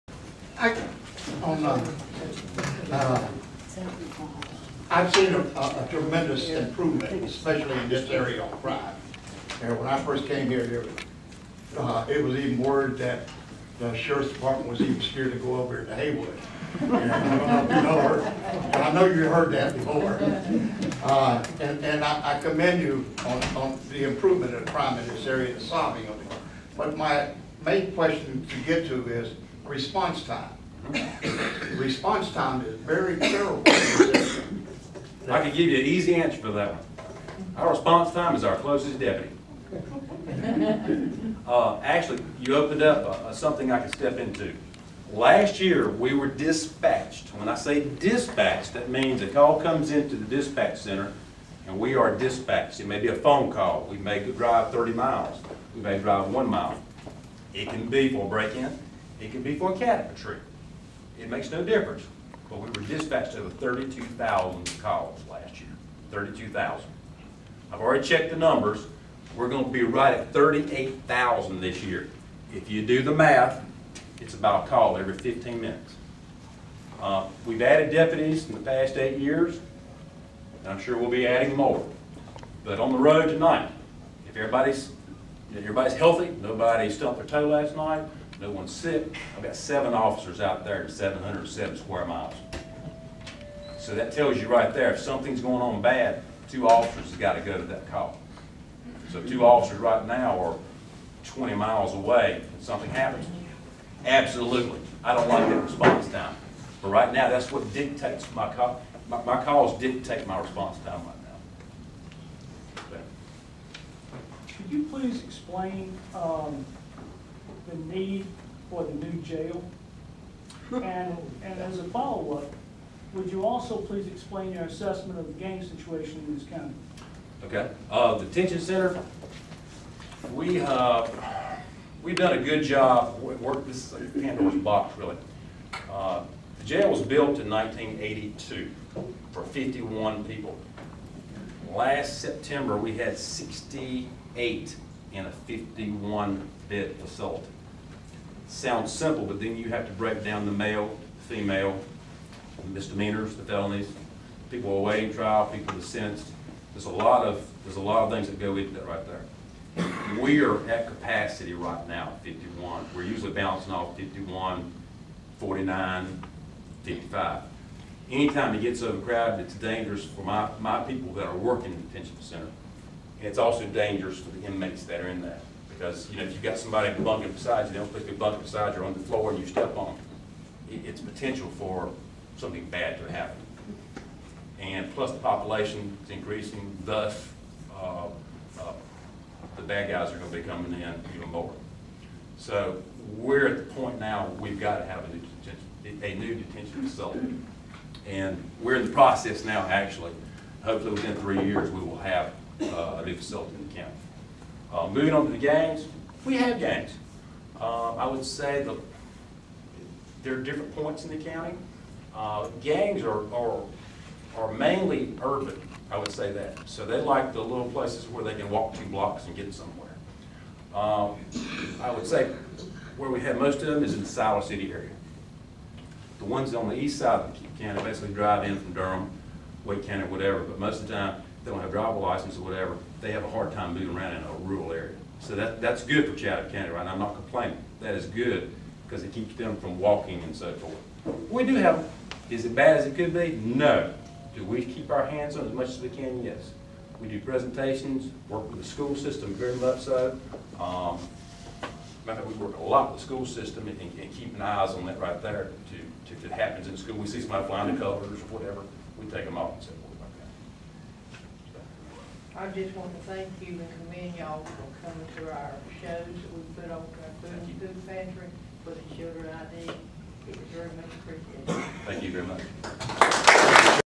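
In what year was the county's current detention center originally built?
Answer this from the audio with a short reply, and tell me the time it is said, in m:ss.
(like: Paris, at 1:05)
1982, at 2:17.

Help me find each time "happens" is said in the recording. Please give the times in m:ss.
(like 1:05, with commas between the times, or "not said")
1:42, 3:03, 4:16.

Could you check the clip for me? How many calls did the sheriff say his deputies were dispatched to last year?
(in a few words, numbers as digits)
32,000.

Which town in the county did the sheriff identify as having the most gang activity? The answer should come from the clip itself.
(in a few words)
Siler City.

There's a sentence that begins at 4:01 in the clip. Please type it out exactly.
We do have, is it bad as it could be?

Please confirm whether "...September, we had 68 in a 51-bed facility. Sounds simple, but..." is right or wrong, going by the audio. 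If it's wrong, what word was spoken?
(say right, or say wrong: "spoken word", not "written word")
right.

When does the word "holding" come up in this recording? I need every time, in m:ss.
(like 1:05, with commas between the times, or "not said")
not said.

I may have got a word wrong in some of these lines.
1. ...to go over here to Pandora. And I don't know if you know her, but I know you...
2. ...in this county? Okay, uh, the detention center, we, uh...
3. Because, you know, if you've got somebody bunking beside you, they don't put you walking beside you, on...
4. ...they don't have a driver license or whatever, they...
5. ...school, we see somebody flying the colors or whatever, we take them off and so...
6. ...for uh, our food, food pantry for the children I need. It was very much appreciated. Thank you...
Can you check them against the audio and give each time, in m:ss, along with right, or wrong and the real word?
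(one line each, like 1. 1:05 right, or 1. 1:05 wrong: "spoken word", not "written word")
1. 0:15 wrong: "Haywood", not "Pandora"
2. 2:06 right
3. 2:55 wrong: "bunking", not "walking"
4. 3:51 right
5. 4:16 right
6. 4:26 right.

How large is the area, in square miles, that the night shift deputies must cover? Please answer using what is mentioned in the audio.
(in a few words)
707 square miles.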